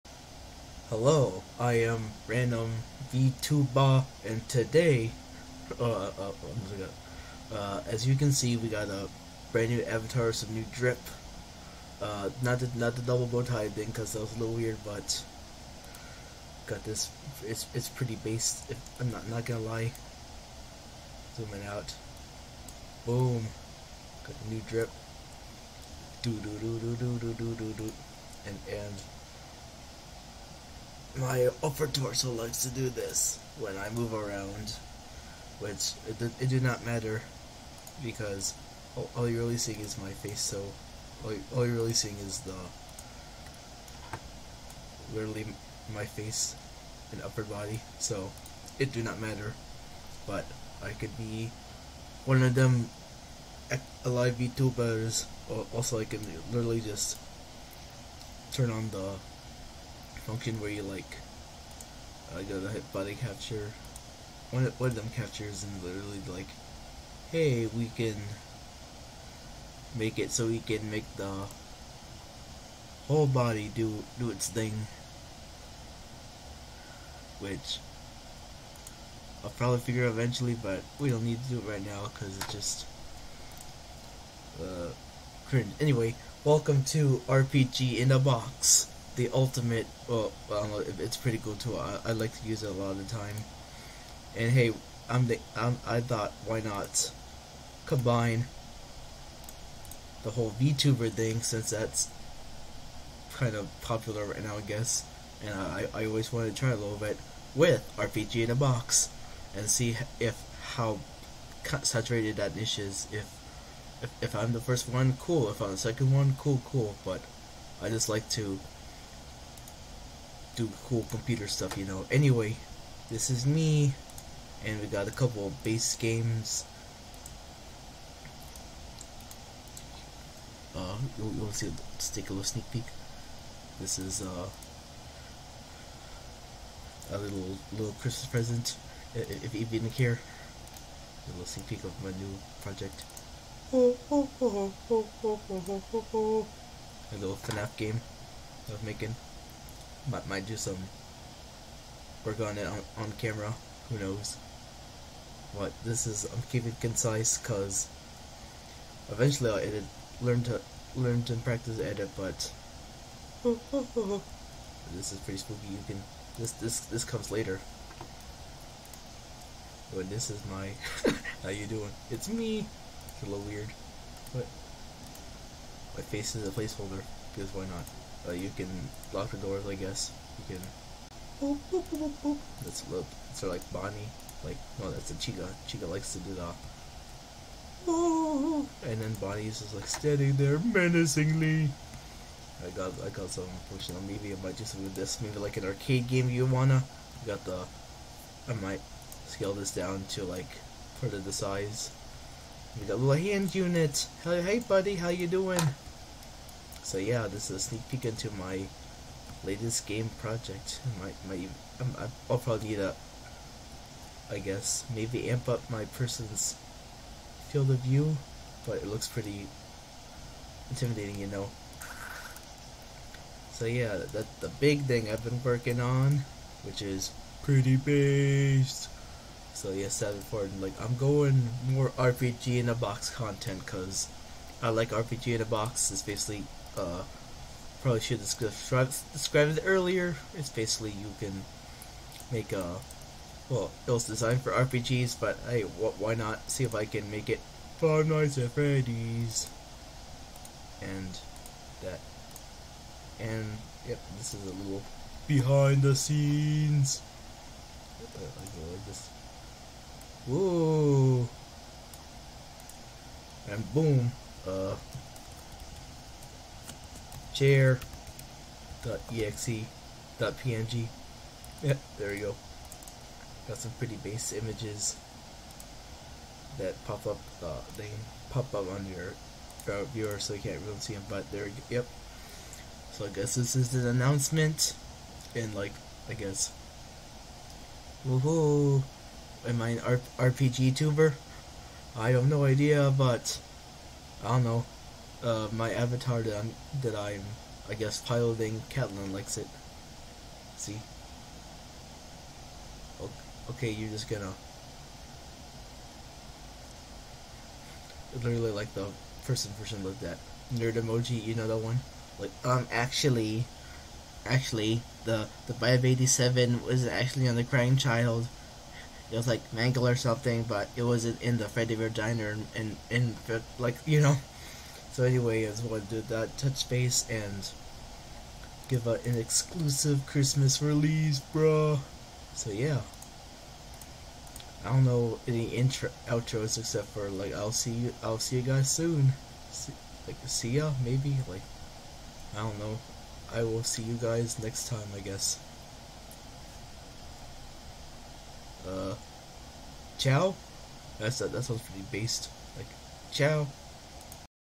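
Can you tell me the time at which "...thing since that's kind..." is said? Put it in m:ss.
1:41.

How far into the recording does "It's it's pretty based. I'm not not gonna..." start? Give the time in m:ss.
0:17.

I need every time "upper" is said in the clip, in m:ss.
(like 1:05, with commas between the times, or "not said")
0:31, 0:47.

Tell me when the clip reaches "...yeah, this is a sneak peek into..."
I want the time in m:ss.
3:26.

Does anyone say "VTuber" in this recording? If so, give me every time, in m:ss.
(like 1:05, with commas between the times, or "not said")
0:03, 0:54, 1:40.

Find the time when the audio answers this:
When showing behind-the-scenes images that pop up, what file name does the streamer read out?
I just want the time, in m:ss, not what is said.
4:27.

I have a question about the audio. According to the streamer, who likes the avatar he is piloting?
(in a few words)
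Catelyn.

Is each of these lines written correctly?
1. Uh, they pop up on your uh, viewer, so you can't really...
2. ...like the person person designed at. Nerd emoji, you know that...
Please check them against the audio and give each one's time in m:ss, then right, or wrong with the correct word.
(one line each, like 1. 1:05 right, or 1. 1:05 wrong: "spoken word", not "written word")
1. 4:37 right
2. 5:08 wrong: "looked", not "designed".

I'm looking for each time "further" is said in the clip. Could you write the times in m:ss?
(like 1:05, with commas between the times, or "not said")
3:21.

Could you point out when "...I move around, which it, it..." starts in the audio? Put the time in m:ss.
0:33.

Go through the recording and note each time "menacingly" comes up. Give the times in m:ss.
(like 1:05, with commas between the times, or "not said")
3:10.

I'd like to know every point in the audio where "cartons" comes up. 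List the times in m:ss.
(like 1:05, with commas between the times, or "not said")
not said.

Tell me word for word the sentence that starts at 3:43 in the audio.
So yeah, that's the big thing I've been working on, which is pretty based.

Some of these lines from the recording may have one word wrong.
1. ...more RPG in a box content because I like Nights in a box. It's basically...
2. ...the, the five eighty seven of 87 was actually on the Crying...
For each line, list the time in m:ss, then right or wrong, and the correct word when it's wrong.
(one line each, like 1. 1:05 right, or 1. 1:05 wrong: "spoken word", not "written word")
1. 3:51 wrong: "RPG", not "Nights"
2. 5:15 right.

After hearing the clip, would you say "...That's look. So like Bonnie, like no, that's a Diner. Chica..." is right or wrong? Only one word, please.
wrong.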